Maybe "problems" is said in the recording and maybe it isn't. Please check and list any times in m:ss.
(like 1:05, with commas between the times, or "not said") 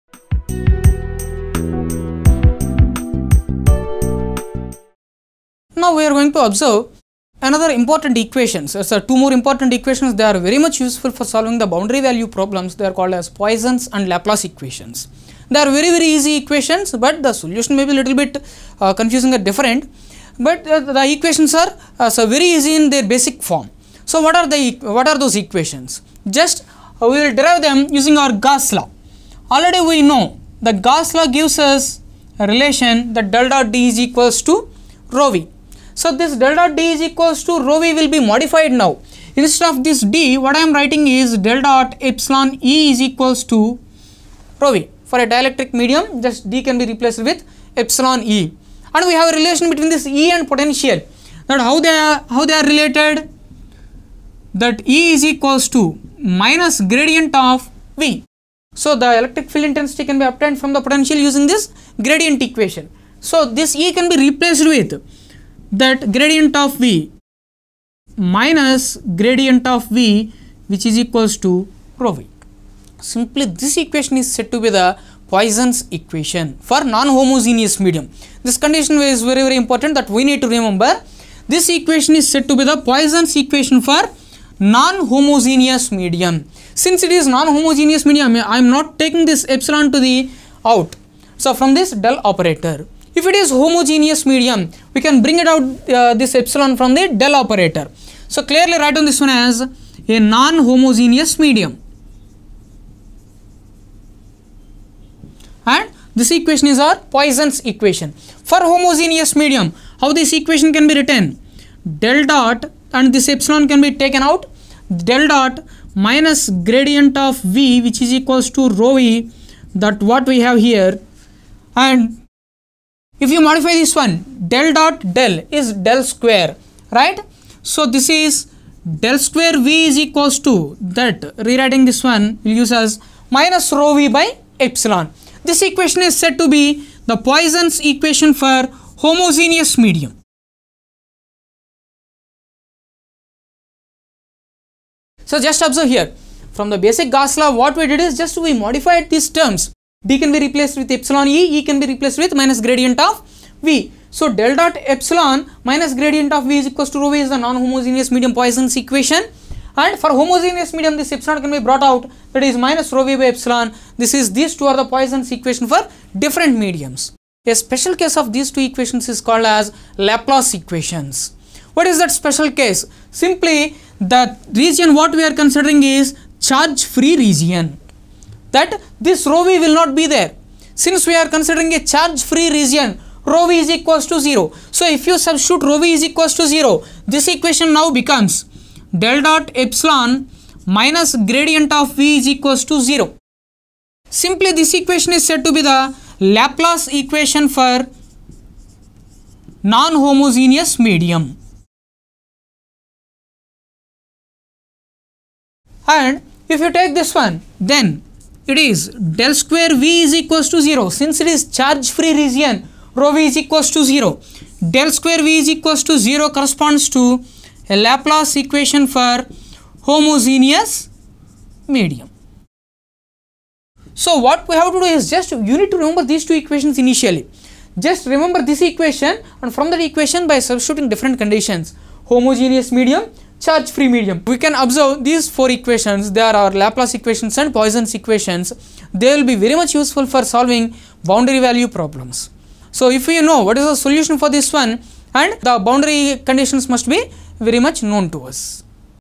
0:12, 4:01.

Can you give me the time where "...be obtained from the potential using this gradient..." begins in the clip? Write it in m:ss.
1:00.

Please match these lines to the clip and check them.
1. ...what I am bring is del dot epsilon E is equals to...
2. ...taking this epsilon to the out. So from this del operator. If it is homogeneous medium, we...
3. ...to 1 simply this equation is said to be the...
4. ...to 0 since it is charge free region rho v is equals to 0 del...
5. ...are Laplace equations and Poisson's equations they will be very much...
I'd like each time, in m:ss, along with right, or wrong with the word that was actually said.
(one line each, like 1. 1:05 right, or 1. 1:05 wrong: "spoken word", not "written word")
1. 0:40 wrong: "writing", not "bring"
2. 1:28 right
3. 3:12 wrong: "0", not "1"
4. 3:30 right
5. 3:56 right.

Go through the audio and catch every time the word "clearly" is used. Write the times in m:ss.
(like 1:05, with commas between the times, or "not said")
1:38.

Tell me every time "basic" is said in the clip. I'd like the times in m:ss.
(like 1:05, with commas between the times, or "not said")
0:23, 2:26.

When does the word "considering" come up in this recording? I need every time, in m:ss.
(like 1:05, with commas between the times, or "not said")
2:55, 3:01.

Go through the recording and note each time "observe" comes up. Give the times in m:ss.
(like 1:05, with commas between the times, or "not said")
0:06, 2:25, 3:54.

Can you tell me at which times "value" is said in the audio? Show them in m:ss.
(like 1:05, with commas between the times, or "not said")
0:12, 4:01.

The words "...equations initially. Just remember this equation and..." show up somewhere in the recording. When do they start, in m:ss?
3:46.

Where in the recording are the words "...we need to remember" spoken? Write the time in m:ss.
1:20.